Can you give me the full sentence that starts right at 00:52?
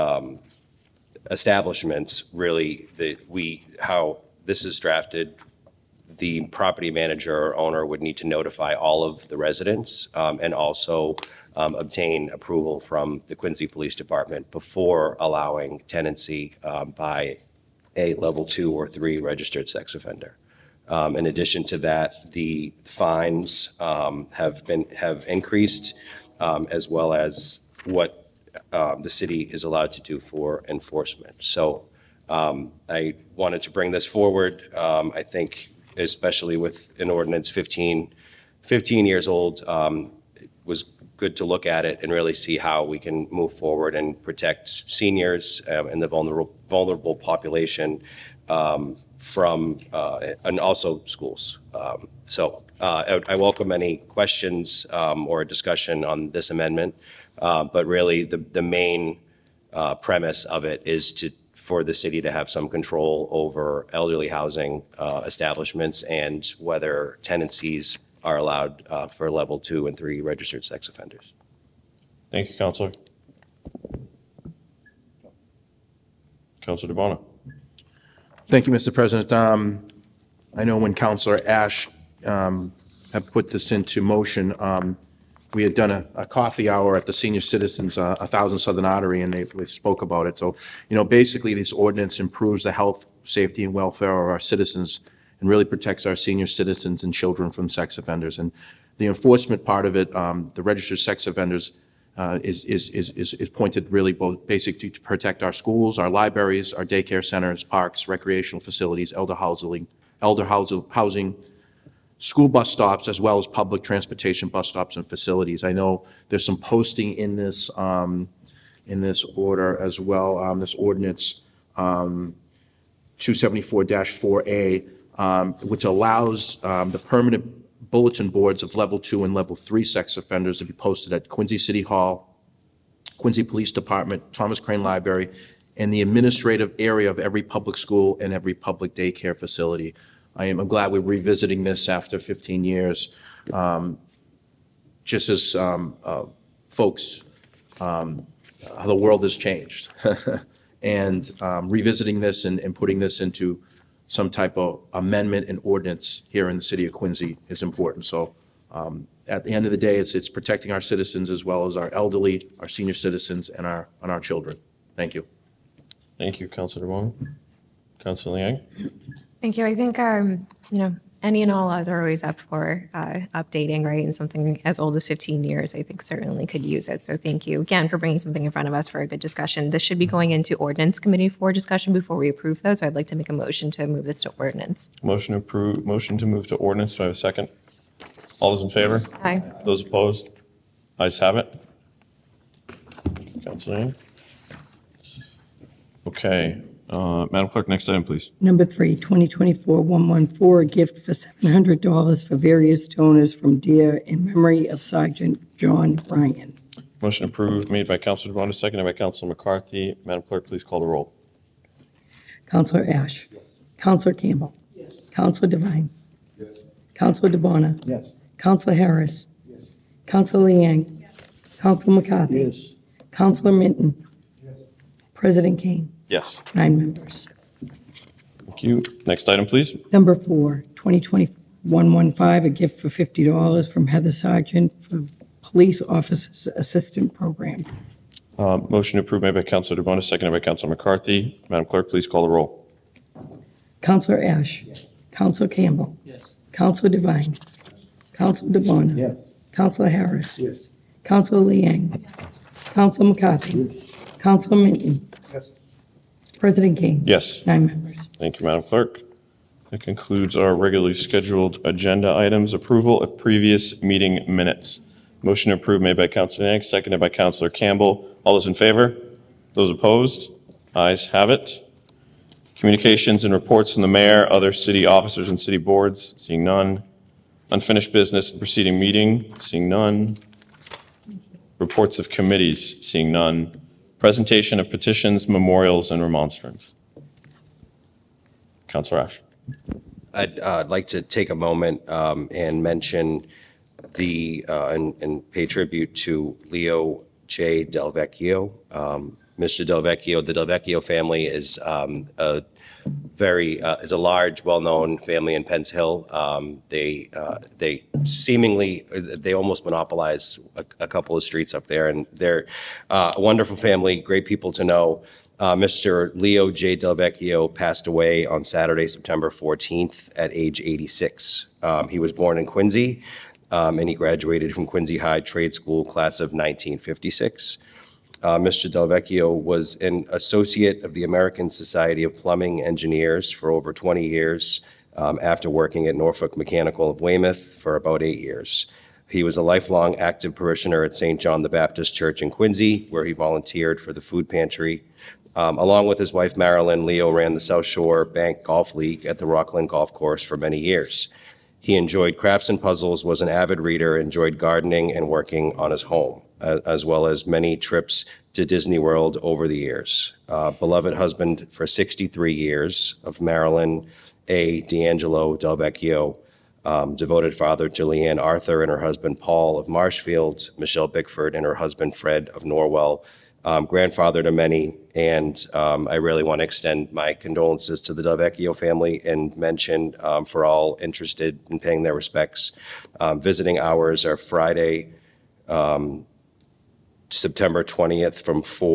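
so uh, I, I, welcome any questions or discussion on this amendment.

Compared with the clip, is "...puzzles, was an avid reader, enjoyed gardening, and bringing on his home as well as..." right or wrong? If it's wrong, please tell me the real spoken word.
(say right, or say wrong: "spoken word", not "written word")
wrong: "working", not "bringing".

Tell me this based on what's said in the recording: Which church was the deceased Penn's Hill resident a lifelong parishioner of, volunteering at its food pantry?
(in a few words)
St. John the Baptist Church.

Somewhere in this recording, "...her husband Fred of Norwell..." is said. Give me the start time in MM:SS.
06:11.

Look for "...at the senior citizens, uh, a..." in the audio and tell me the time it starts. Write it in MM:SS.
01:26.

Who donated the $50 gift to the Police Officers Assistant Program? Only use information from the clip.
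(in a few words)
Heather Sargent.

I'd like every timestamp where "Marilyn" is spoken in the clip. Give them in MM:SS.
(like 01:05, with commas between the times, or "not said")
05:46, 06:03.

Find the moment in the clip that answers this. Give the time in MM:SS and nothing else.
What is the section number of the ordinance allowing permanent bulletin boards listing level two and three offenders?
02:03.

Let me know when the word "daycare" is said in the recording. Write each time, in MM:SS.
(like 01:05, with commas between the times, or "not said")
01:46, 02:18.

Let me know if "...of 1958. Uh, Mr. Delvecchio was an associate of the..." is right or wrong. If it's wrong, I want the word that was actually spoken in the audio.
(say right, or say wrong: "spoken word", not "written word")
wrong: "1956", not "1958".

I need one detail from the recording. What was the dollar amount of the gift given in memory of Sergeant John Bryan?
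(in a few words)
$700.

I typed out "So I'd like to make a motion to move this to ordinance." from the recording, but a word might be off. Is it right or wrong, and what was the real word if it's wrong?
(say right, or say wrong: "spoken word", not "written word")
right.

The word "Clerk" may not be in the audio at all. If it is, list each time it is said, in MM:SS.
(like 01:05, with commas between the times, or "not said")
03:17, 03:30, 04:01, 04:18.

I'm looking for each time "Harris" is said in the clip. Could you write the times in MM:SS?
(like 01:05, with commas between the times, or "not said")
03:38, 04:09.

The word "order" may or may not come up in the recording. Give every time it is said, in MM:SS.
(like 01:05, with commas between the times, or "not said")
01:59.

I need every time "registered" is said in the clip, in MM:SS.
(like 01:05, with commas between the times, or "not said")
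00:19, 01:10, 01:40.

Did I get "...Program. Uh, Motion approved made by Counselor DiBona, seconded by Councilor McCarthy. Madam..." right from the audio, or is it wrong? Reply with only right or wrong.
right.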